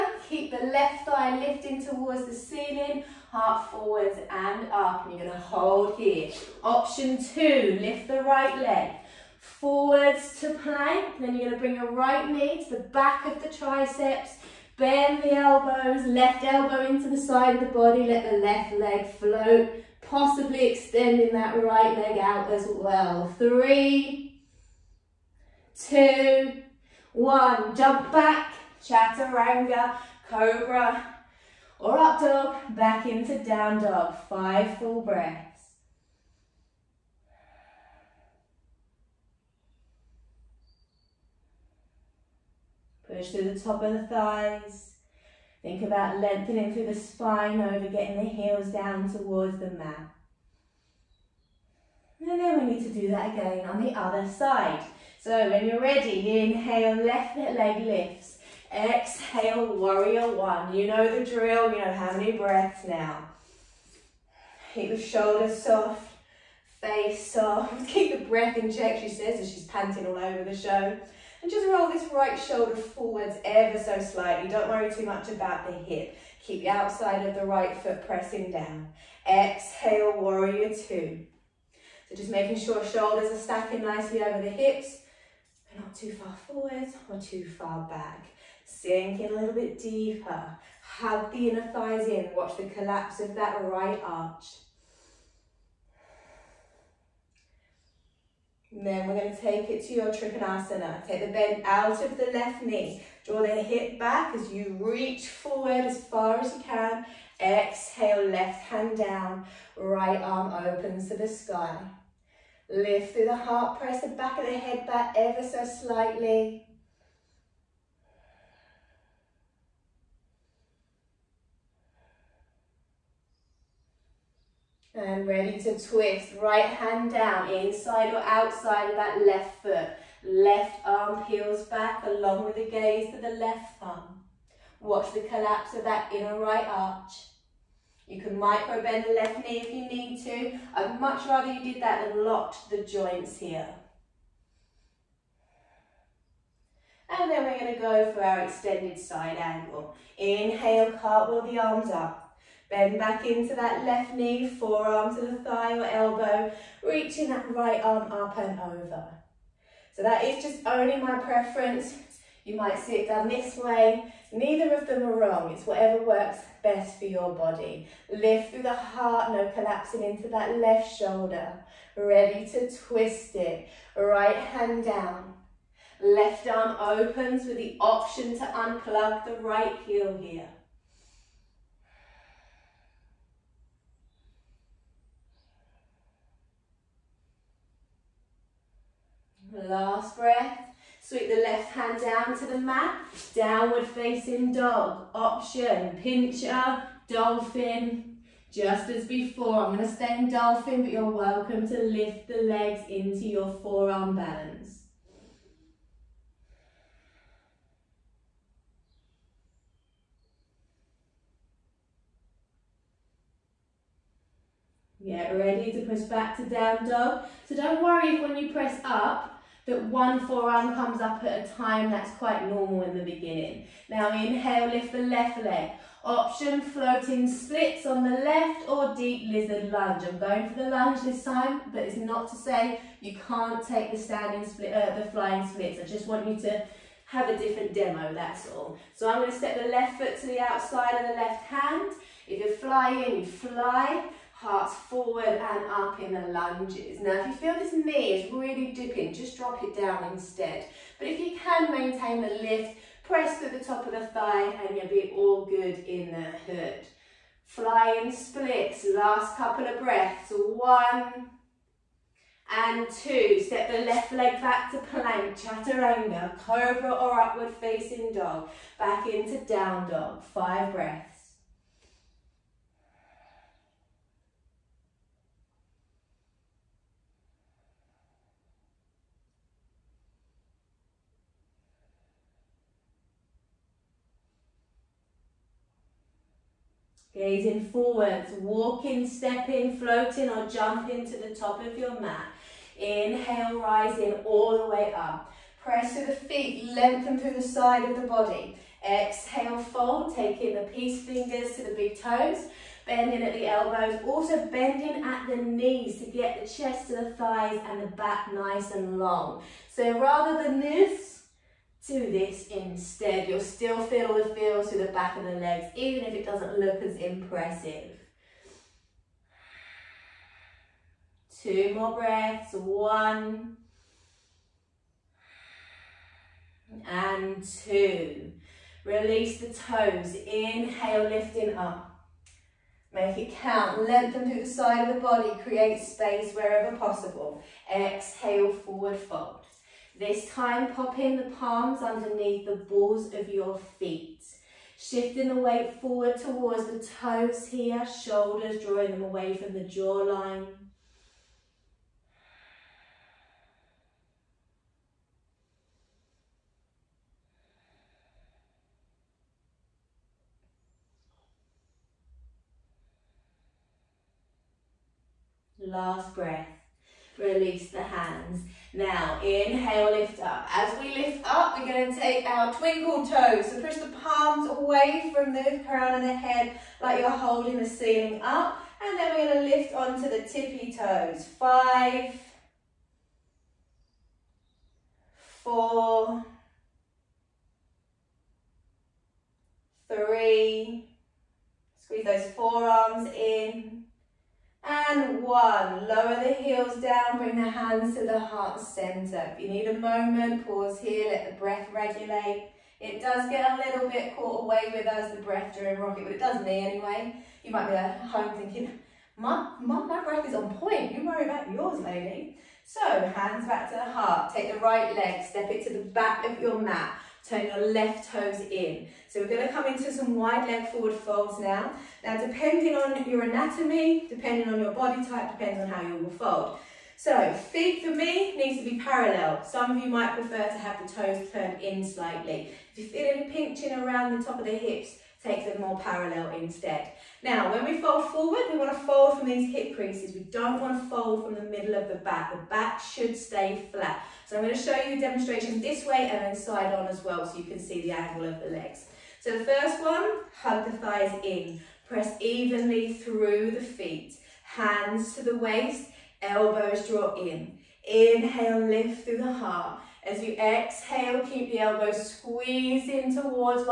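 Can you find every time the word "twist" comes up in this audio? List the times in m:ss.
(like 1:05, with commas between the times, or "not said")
2:05, 2:52.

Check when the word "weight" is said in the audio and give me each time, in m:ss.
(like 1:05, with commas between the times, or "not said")
5:45.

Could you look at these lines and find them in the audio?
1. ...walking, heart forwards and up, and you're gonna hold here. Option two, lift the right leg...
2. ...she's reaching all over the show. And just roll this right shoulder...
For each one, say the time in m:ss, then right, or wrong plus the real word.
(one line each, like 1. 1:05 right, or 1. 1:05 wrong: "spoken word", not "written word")
1. 0:02 wrong: "ceiling", not "walking"
2. 1:09 wrong: "panting", not "reaching".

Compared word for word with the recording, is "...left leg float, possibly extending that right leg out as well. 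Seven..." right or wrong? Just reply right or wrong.
wrong.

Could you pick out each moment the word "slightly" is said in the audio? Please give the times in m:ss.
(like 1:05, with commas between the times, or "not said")
1:13, 1:55, 7:11.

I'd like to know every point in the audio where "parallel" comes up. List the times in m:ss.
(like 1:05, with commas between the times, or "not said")
7:08, 7:15.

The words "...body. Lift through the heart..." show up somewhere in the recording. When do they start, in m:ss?
2:47.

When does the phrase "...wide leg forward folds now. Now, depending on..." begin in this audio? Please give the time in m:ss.
7:00.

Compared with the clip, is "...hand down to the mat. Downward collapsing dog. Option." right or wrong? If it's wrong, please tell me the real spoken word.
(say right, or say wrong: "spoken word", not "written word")
wrong: "facing", not "collapsing".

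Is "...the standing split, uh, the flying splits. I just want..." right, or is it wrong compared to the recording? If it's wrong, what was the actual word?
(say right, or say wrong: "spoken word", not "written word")
right.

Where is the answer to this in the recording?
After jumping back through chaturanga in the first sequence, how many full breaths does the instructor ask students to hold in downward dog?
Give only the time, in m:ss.
0:34.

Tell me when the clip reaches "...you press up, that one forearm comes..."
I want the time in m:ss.
3:38.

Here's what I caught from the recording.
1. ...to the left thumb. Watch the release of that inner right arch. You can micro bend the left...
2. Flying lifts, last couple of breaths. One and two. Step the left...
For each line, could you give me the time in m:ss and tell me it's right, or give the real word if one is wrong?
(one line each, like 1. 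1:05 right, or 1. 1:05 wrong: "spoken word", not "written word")
1. 2:13 wrong: "collapse", not "release"
2. 4:17 wrong: "splits", not "lifts".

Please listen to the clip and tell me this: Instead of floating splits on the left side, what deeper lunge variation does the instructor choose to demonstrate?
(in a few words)
deep lizard lunge.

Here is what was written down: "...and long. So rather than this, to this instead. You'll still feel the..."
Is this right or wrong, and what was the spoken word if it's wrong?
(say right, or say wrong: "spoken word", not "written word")
right.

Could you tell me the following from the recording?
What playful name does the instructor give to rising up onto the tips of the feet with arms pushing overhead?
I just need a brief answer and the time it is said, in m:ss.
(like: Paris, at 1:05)
twinkle toes, at 6:12.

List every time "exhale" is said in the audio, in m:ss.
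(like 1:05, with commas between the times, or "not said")
0:58, 1:19, 1:47, 4:58, 5:37, 7:40.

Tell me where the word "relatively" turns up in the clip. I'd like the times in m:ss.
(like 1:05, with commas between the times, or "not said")
not said.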